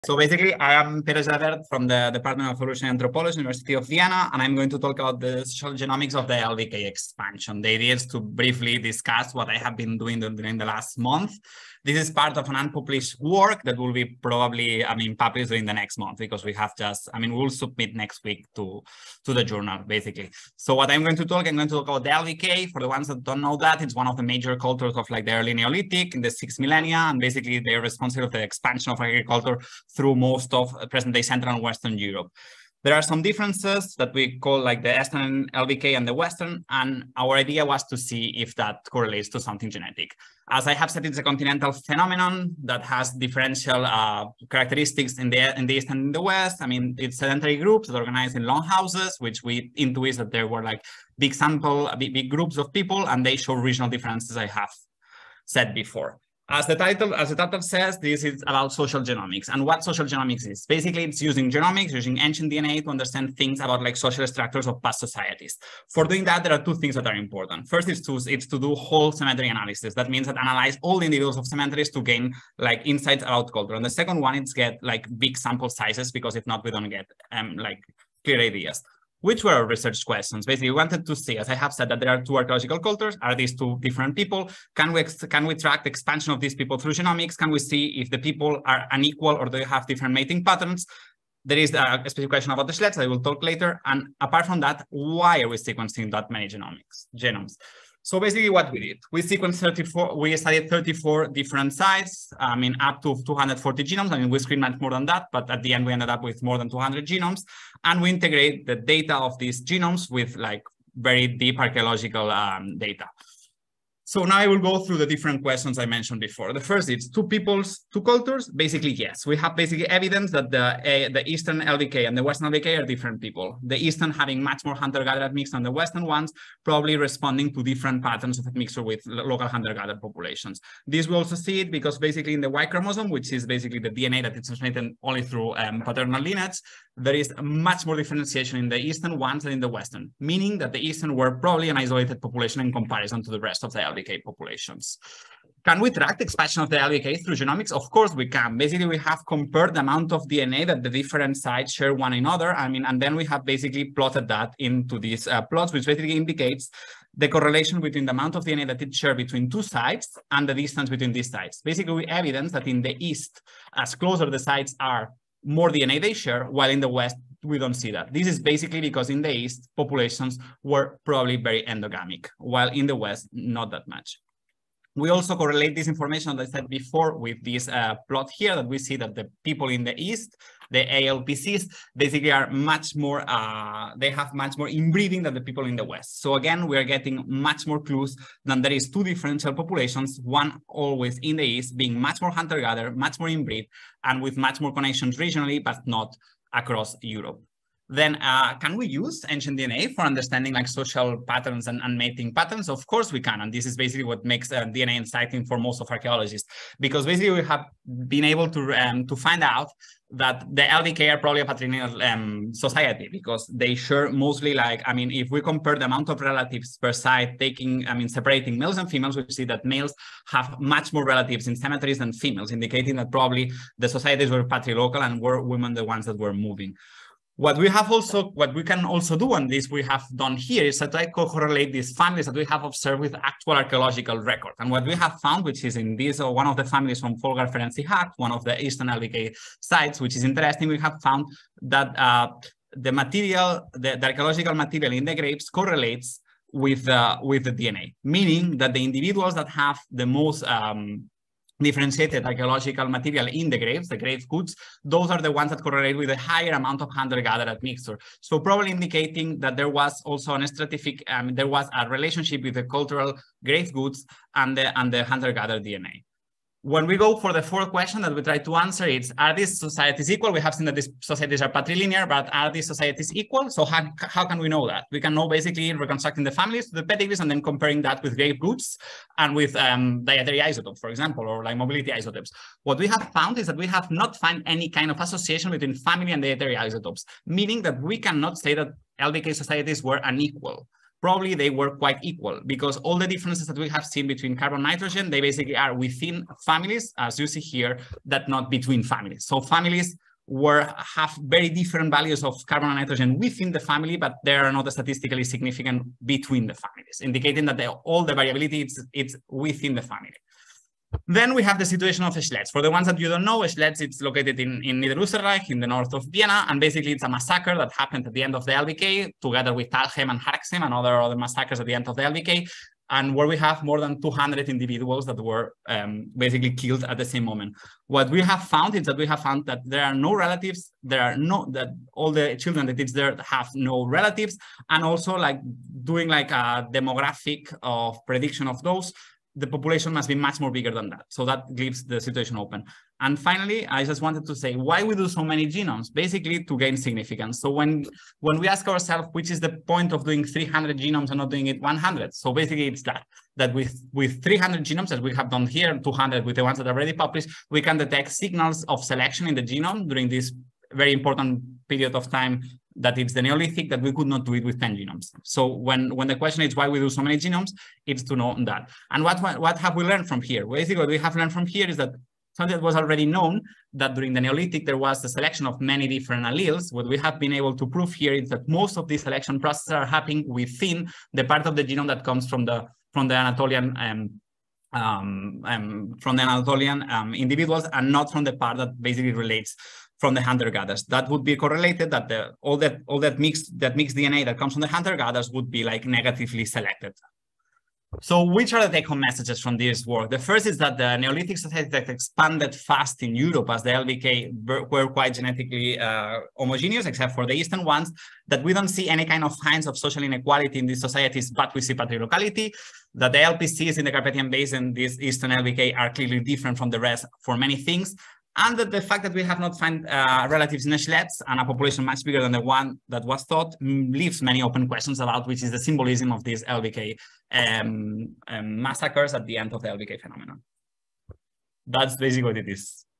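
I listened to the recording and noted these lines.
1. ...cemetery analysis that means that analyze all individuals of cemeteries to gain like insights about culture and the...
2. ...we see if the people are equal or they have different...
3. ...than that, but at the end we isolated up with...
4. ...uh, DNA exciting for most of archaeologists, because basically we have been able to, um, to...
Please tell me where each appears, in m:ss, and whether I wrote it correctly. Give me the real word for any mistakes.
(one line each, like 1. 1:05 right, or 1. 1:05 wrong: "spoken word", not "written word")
1. 1:09 right
2. 1:27 wrong: "unequal", not "equal"
3. 1:44 wrong: "ended", not "isolated"
4. 3:24 right.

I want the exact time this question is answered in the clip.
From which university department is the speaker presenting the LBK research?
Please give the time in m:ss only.
0:02.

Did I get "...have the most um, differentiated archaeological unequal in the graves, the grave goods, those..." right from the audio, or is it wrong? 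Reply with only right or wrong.
wrong.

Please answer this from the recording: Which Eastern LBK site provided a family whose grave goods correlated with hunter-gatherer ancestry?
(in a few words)
Polgár-Ferenci-hát.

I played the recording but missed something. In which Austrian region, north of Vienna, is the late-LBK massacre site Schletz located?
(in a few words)
Niederösterreich.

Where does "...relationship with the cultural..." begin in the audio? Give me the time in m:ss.
4:21.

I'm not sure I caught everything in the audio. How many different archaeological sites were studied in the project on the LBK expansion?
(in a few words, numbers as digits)
34.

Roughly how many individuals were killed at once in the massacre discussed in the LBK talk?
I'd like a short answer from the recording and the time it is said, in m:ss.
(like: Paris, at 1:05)
More than 200, at 5:23.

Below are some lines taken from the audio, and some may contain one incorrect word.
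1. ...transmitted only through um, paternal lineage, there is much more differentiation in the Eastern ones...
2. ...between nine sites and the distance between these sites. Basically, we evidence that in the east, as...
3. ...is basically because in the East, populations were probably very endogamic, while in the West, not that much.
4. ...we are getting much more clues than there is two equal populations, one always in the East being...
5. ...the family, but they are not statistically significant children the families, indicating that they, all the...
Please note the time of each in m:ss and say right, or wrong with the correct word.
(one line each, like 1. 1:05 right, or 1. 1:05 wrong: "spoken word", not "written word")
1. 2:14 right
2. 2:39 wrong: "two", not "nine"
3. 2:48 right
4. 3:06 wrong: "differential", not "equal"
5. 5:03 wrong: "between", not "children".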